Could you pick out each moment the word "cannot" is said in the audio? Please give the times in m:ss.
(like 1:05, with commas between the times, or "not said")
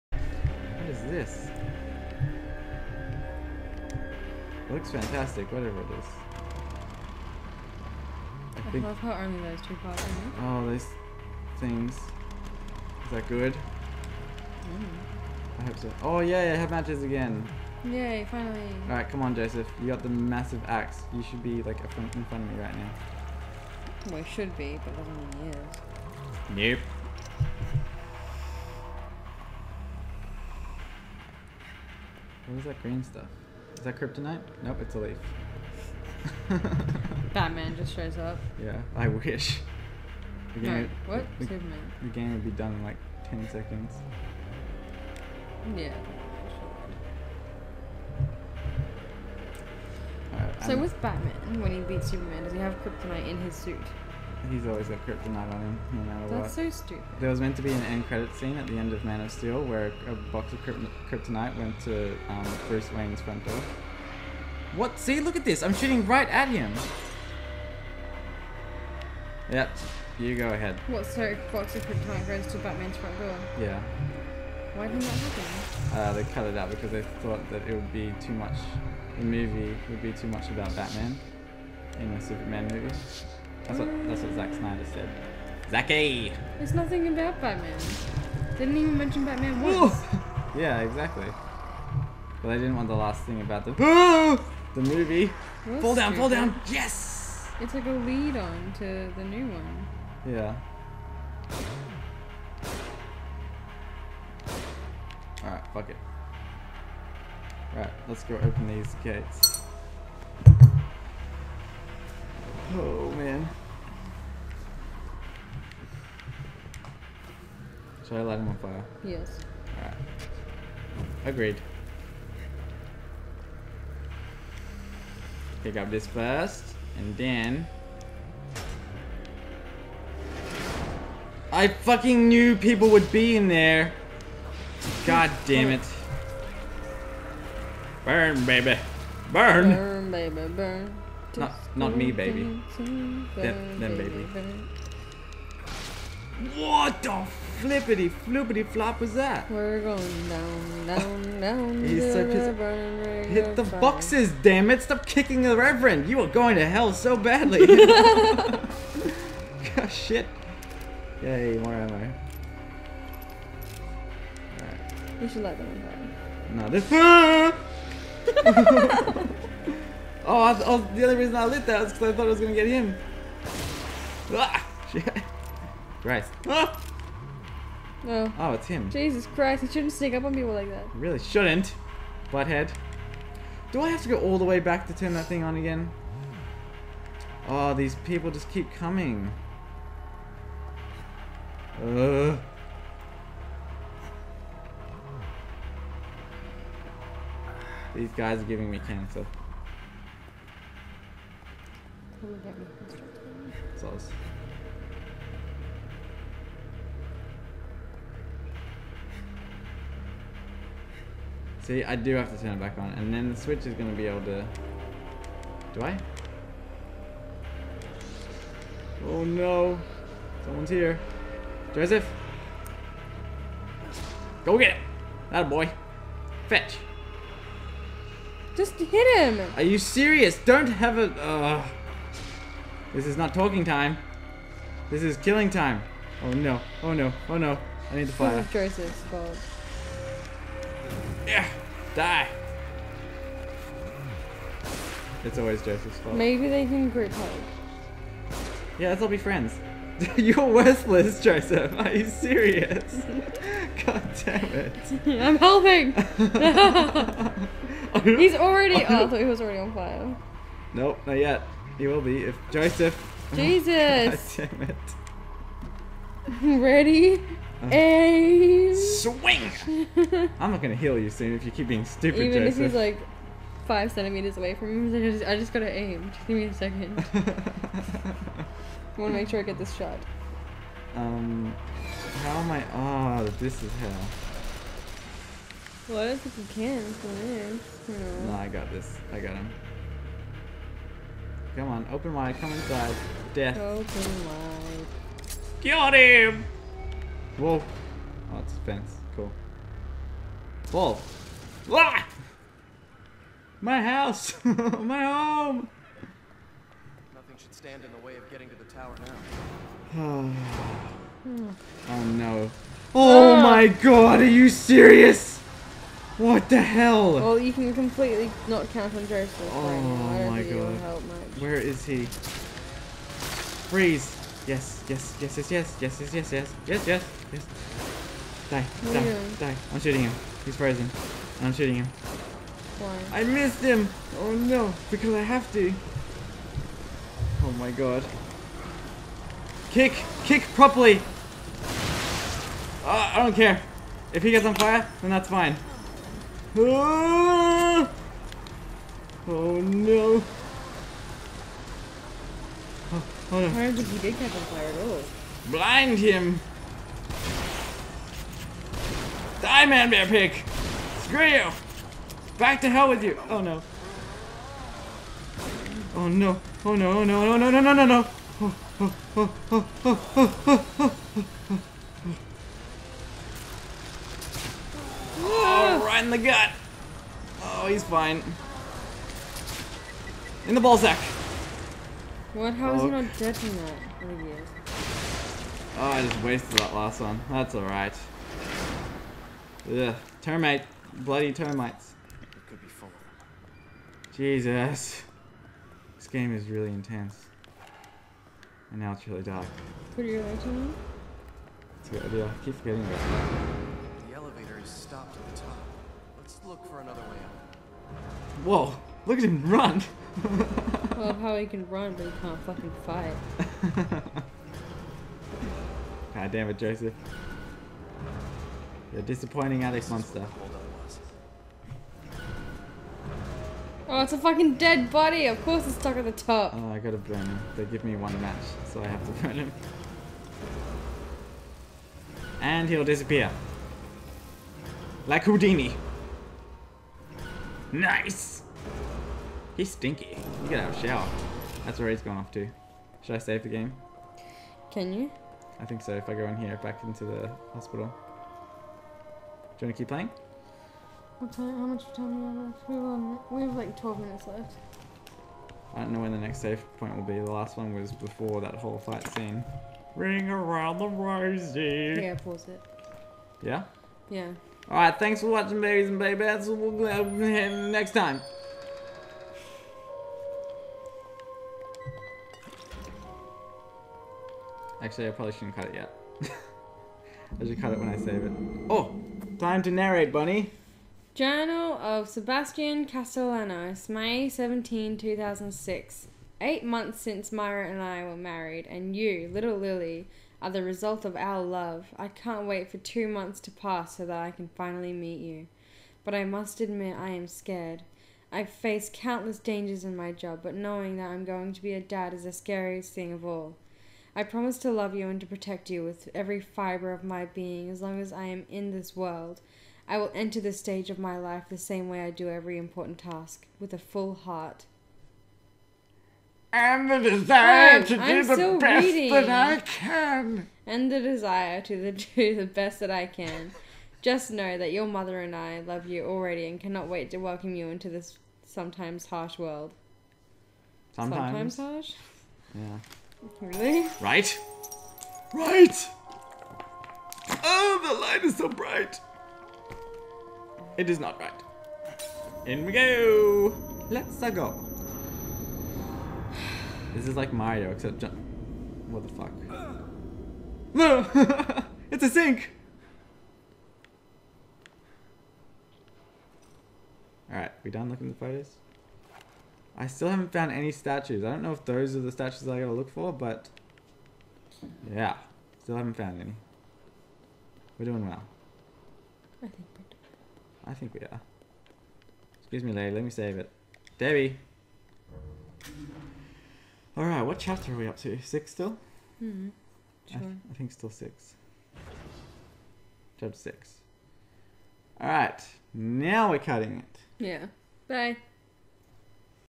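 8:46.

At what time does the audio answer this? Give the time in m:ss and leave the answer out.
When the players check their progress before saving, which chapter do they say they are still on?
9:43.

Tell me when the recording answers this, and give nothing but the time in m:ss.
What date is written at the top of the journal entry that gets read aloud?
8:03.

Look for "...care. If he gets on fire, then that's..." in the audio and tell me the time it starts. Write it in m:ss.
5:43.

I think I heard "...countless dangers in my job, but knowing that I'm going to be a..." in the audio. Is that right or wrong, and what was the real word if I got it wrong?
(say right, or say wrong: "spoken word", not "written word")
right.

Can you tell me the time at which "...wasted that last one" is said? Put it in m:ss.
6:26.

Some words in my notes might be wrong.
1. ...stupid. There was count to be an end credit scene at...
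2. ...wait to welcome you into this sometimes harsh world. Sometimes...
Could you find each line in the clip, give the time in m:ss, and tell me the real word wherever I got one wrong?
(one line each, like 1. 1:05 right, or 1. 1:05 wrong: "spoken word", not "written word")
1. 0:56 wrong: "meant", not "count"
2. 8:46 right.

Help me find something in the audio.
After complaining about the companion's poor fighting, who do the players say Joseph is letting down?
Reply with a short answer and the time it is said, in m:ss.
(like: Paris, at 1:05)
Attikmonsta, at 6:59.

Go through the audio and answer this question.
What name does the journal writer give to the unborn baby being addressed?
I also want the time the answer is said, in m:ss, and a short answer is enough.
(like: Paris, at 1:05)
Lily, at 8:09.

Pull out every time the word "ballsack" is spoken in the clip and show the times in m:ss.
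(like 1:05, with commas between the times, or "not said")
6:20.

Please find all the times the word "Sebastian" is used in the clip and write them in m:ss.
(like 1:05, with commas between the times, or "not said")
8:02.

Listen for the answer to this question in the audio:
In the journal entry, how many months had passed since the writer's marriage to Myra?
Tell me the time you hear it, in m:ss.
8:06.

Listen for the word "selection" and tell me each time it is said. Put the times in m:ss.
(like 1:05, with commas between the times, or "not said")
not said.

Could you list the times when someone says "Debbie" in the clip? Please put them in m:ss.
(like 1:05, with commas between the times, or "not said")
9:33.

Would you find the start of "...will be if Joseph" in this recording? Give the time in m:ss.
4:21.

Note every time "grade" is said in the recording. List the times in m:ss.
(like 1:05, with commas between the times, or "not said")
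not said.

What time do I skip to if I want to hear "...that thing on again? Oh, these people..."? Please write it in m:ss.
3:05.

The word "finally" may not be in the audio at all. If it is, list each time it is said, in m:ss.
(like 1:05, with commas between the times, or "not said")
0:18, 8:14.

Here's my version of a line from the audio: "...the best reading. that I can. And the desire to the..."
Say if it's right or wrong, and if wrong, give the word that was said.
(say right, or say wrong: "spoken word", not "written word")
right.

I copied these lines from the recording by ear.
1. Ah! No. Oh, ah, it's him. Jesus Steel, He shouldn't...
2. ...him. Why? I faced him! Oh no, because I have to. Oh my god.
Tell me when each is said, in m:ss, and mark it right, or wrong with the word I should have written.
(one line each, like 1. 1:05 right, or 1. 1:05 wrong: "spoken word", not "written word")
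1. 2:56 wrong: "Christ", not "Steel"
2. 5:31 wrong: "missed", not "faced".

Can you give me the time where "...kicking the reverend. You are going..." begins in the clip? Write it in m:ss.
2:35.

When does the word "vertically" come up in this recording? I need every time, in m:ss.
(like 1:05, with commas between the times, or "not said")
not said.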